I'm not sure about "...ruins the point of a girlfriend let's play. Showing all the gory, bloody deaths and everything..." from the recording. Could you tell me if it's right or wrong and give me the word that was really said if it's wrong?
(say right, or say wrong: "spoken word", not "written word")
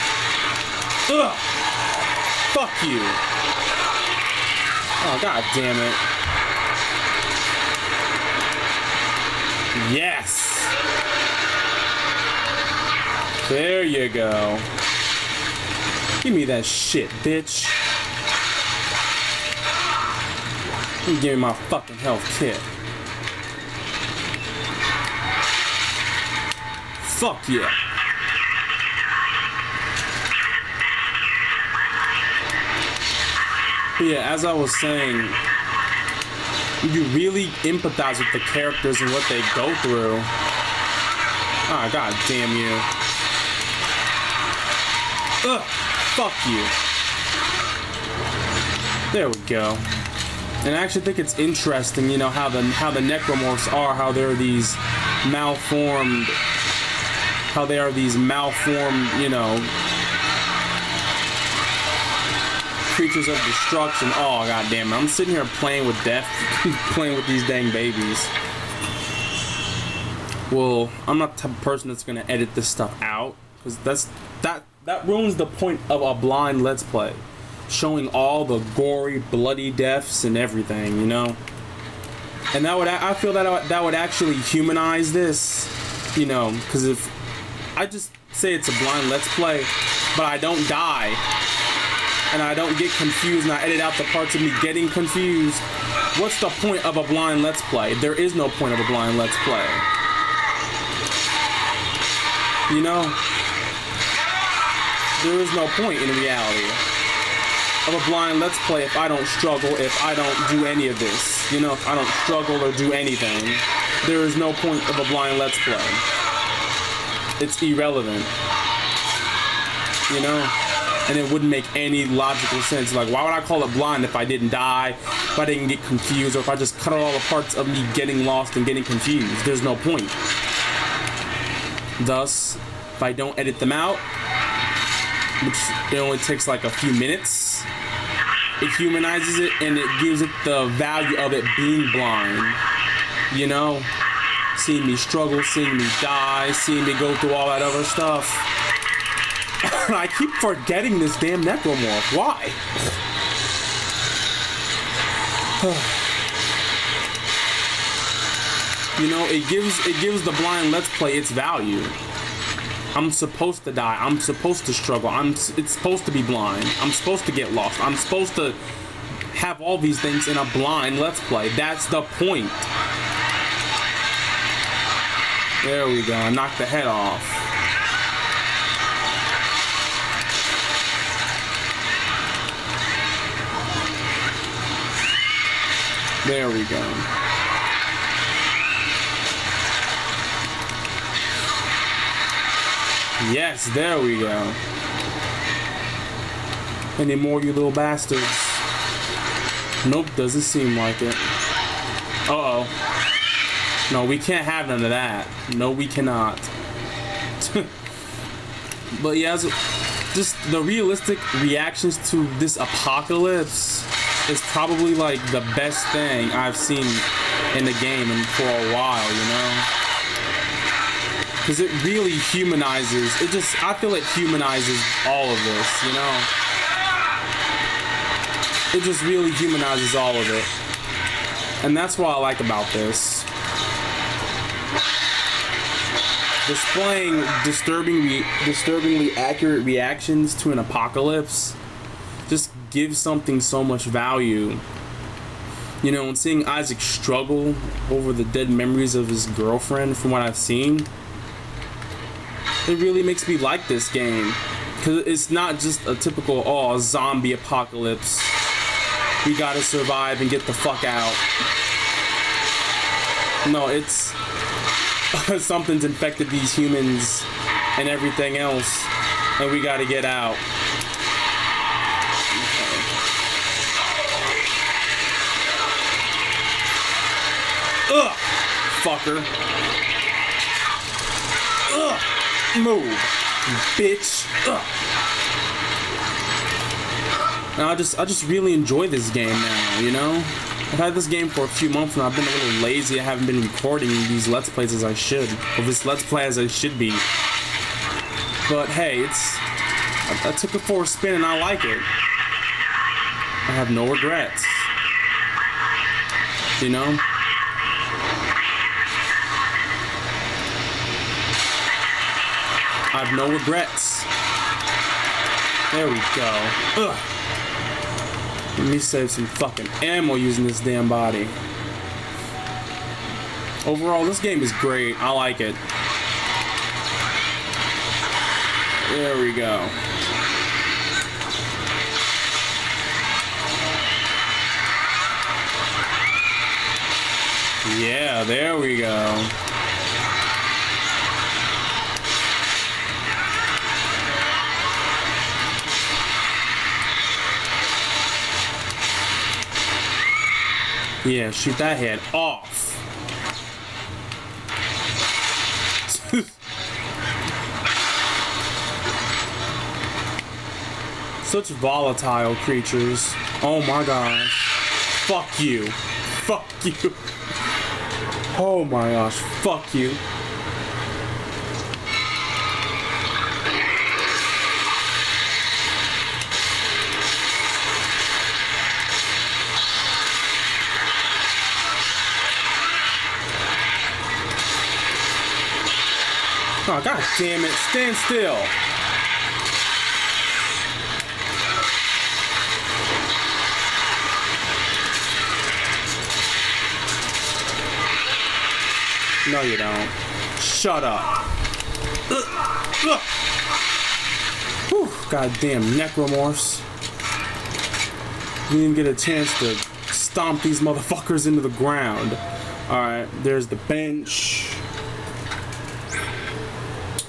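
wrong: "blind", not "girlfriend".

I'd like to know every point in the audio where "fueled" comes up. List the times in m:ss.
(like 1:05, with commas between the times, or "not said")
not said.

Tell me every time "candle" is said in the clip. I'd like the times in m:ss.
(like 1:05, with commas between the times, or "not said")
not said.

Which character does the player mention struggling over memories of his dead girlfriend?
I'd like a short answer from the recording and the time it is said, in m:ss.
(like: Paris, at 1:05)
Isaac, at 4:06.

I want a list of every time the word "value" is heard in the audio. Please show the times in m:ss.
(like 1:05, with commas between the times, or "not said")
2:20, 2:41, 4:03.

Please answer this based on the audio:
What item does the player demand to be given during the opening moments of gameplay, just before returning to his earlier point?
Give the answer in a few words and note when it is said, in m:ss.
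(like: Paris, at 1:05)
health kit, at 0:21.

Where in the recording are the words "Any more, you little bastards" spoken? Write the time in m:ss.
3:16.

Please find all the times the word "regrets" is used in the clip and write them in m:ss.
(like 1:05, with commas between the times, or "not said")
5:03, 5:13.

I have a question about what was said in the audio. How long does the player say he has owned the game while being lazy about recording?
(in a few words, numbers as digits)
a few months.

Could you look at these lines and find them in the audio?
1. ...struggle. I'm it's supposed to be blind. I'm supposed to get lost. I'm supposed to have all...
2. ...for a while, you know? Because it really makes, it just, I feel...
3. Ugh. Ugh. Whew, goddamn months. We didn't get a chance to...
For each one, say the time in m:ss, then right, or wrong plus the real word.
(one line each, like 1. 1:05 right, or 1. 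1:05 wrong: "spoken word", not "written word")
1. 2:44 right
2. 3:38 wrong: "humanizes", not "makes"
3. 6:42 wrong: "necromorphs", not "months".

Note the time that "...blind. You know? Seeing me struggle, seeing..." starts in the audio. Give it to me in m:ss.
2:21.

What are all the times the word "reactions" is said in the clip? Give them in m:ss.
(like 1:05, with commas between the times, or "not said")
3:31, 3:59.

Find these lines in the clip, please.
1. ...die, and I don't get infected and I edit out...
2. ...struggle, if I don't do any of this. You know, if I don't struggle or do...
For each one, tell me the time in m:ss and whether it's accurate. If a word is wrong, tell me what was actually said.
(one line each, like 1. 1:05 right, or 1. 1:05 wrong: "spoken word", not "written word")
1. 1:30 wrong: "confused", not "infected"
2. 1:49 right.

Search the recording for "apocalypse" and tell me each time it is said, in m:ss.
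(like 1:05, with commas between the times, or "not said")
3:32, 4:00, 4:17.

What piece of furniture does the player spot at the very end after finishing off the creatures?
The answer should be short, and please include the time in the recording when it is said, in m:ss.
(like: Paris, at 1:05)
bench, at 6:53.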